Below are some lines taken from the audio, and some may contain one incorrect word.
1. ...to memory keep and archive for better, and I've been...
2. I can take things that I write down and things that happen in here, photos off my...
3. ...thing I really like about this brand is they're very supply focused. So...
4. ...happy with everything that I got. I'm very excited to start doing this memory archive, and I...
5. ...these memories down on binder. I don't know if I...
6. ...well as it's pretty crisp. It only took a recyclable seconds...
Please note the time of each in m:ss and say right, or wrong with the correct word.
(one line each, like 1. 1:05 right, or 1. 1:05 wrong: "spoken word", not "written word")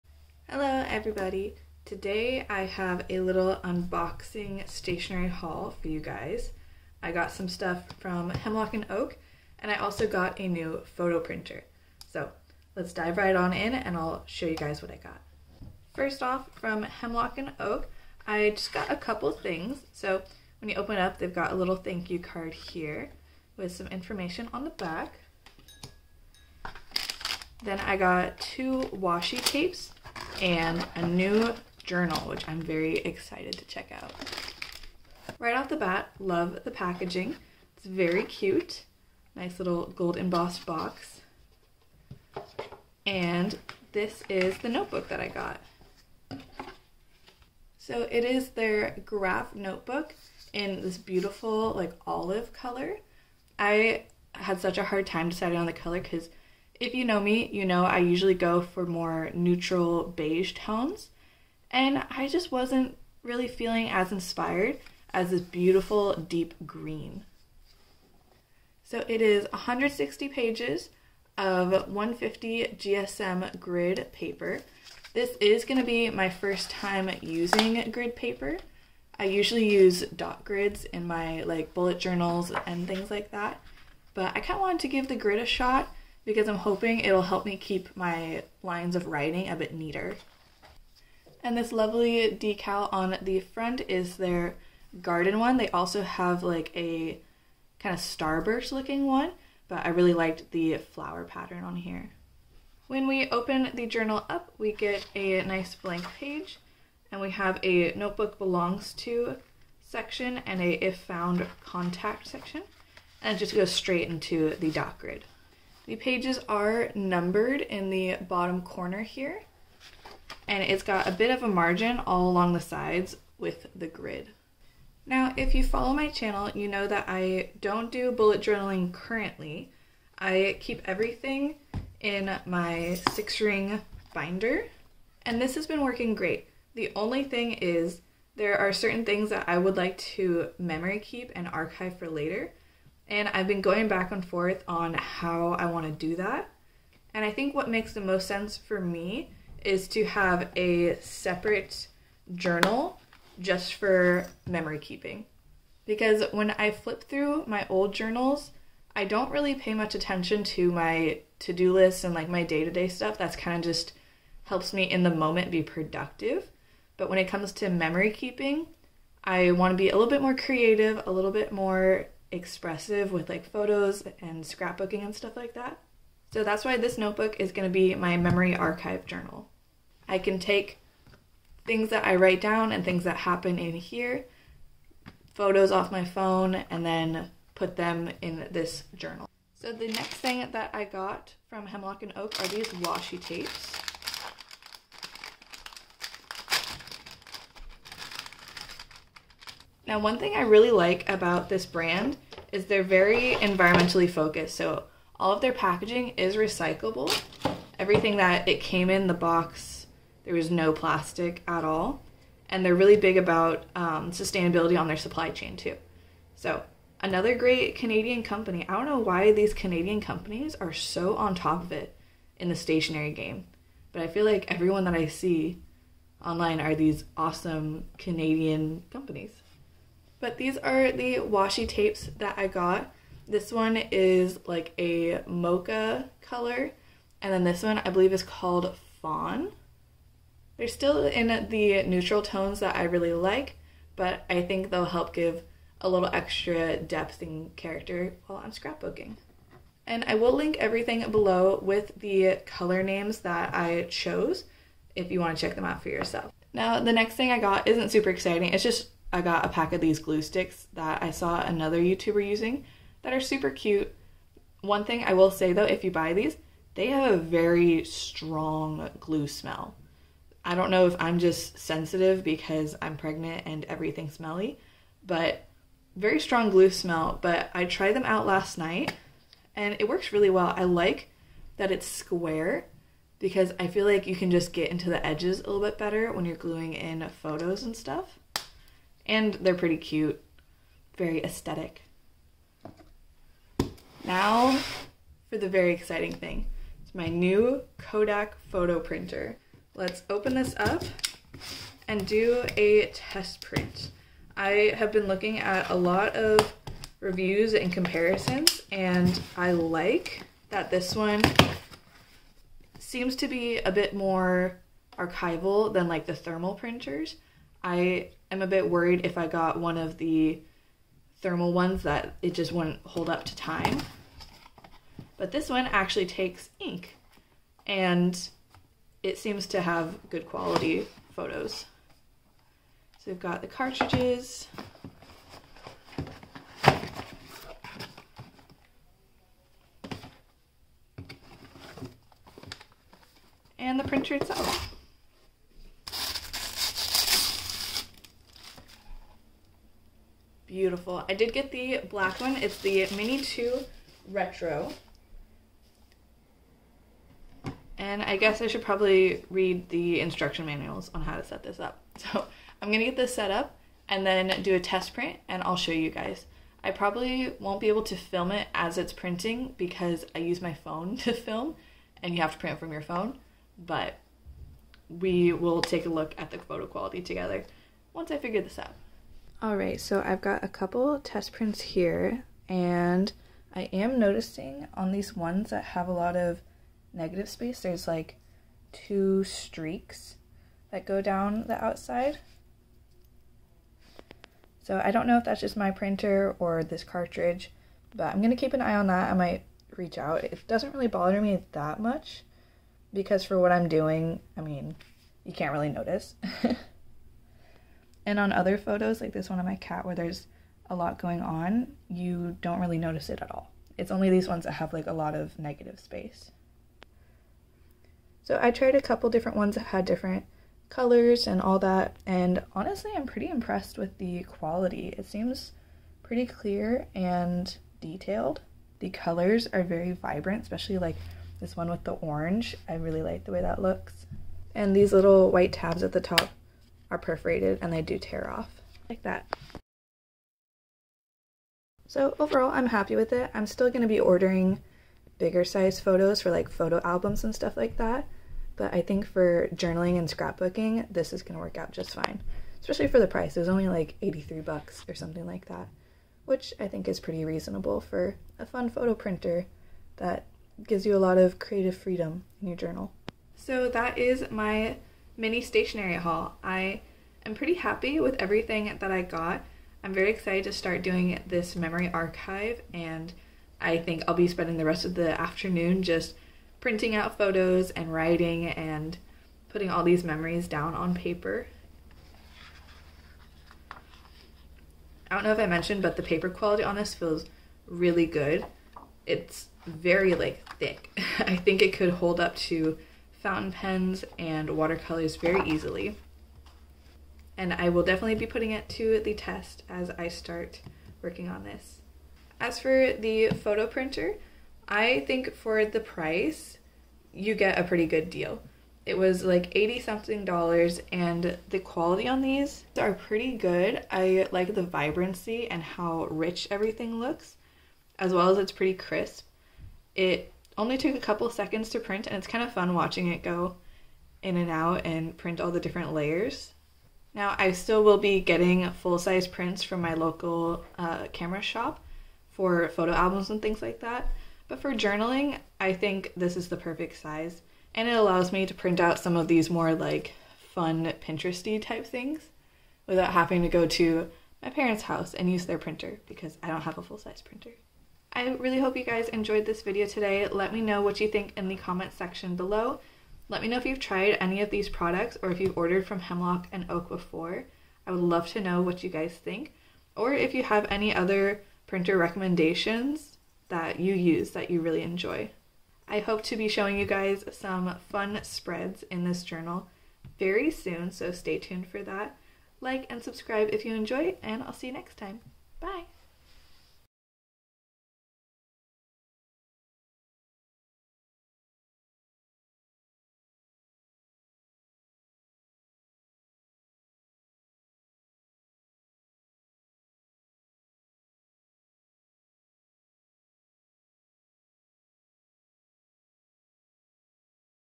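1. 2:19 wrong: "later", not "better"
2. 3:00 right
3. 3:20 wrong: "environmentally", not "supply"
4. 7:47 right
5. 7:59 wrong: "paper", not "binder"
6. 8:38 wrong: "couple", not "recyclable".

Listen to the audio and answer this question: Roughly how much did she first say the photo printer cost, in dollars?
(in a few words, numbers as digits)
83.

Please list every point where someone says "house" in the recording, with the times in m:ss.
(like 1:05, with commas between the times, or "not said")
9:04.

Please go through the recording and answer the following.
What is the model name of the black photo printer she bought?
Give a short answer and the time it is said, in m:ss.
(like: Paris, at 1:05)
Mini 2 Retro, at 5:52.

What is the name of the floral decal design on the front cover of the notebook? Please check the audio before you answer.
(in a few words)
garden.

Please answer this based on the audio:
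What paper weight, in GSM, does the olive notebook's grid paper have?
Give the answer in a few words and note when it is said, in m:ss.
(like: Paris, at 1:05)
150 GSM, at 1:11.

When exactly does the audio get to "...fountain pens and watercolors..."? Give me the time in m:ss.
8:13.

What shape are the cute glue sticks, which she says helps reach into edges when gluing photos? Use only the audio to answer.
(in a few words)
square.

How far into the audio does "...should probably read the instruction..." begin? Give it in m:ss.
5:58.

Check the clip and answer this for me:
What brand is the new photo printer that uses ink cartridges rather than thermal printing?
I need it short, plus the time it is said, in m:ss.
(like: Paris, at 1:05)
Kodak, at 4:57.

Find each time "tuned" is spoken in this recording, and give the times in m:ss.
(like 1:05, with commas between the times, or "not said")
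9:31.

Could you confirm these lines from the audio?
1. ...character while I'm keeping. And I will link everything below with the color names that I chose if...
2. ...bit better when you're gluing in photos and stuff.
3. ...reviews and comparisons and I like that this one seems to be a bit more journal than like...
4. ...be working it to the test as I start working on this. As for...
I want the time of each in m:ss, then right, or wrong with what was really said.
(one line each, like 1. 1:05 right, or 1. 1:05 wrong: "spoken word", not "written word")
1. 4:07 wrong: "scrapbooking", not "keeping"
2. 4:45 right
3. 5:07 wrong: "archival", not "journal"
4. 8:18 wrong: "putting", not "working".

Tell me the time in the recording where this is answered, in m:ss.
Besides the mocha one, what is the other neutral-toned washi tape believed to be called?
3:59.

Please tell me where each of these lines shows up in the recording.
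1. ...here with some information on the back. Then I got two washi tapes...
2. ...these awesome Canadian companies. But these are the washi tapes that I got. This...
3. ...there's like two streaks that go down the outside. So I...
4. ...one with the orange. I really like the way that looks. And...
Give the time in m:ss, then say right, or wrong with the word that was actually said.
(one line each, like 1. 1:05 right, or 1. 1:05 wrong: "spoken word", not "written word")
1. 0:22 right
2. 3:46 right
3. 6:27 right
4. 7:11 right.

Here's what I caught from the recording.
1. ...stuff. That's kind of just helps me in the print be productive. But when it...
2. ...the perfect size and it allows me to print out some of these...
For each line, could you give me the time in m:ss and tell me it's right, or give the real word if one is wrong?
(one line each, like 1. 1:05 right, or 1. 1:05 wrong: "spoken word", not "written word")
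1. 2:42 wrong: "moment", not "print"
2. 8:56 right.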